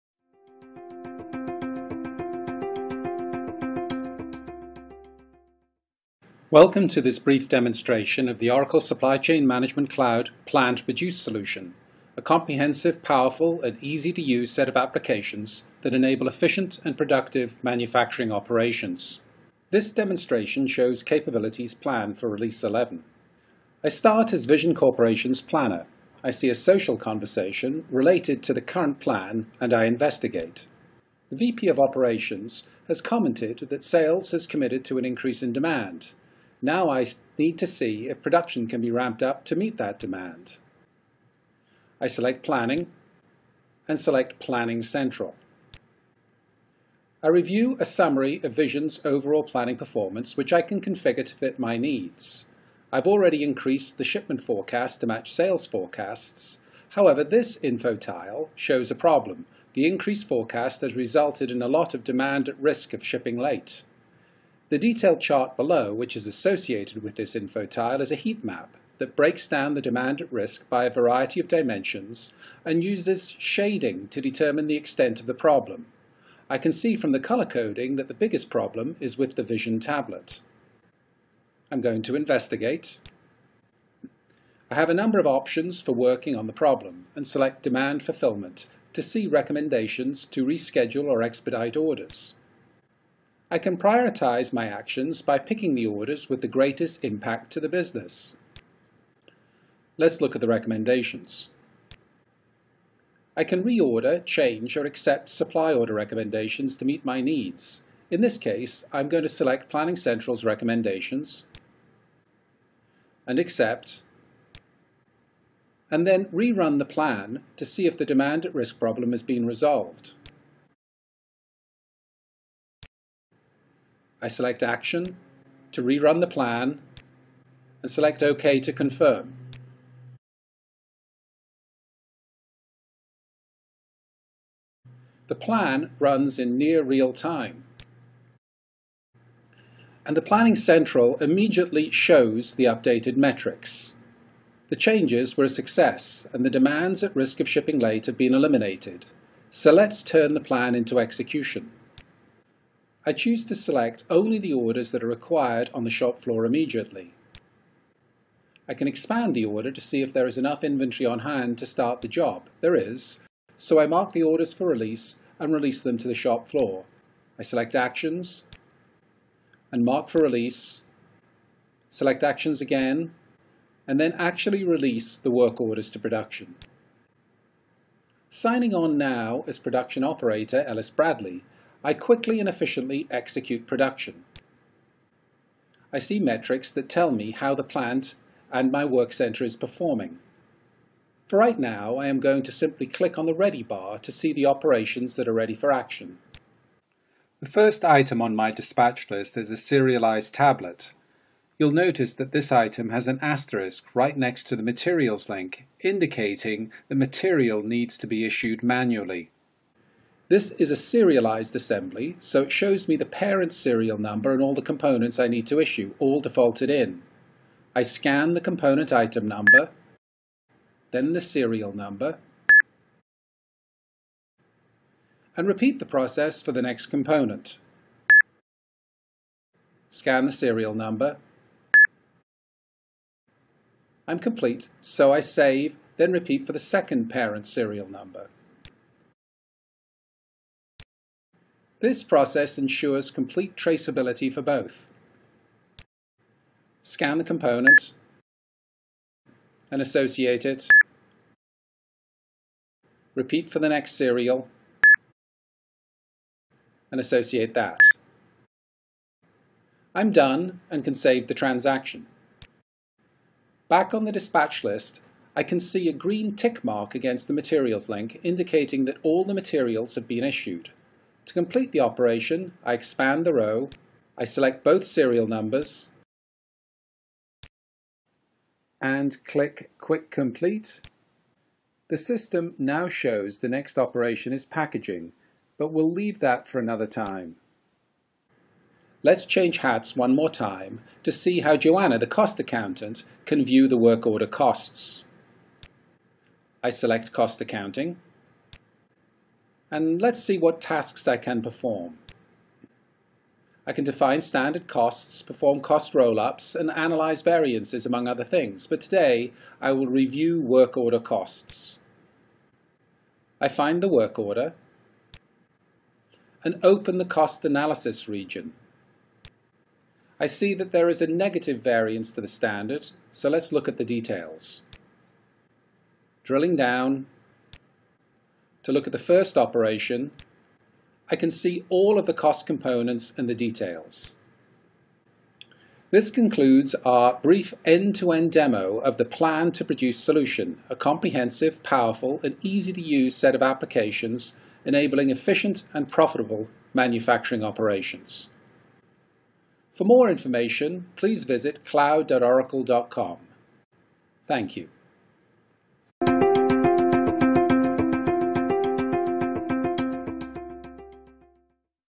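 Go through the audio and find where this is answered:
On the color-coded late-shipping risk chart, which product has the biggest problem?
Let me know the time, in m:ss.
1:19.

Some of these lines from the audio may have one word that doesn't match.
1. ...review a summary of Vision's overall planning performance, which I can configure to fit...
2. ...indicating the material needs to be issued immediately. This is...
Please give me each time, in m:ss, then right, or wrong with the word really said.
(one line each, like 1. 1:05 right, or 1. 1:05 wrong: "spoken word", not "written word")
1. 0:47 right
2. 3:25 wrong: "manually", not "immediately".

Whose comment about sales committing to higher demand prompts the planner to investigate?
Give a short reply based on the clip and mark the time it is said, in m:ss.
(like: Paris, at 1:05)
VP of Operations, at 0:31.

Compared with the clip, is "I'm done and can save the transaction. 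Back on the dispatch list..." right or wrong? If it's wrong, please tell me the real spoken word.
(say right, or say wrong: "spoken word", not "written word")
right.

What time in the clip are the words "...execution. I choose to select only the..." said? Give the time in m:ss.
2:30.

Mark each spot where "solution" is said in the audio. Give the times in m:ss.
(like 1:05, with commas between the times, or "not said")
0:11, 5:39.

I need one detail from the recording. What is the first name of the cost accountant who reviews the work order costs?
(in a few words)
Joanna.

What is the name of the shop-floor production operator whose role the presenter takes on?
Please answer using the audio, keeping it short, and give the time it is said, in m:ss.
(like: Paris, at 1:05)
Ellis Bradley, at 3:00.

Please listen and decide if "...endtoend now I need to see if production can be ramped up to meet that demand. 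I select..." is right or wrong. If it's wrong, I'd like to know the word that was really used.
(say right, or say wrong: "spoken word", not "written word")
wrong: "demand", not "endtoend".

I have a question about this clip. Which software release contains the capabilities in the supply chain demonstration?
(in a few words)
Release 11.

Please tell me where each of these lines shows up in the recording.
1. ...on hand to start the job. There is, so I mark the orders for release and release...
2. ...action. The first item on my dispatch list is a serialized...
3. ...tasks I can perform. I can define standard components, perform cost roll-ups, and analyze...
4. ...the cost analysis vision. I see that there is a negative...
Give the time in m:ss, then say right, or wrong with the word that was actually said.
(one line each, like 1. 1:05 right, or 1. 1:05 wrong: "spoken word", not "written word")
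1. 2:41 right
2. 3:15 right
3. 5:00 wrong: "costs", not "components"
4. 5:16 wrong: "region", not "vision".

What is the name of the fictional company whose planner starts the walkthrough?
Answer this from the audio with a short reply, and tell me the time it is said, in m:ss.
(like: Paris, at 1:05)
Vision Corporation, at 0:24.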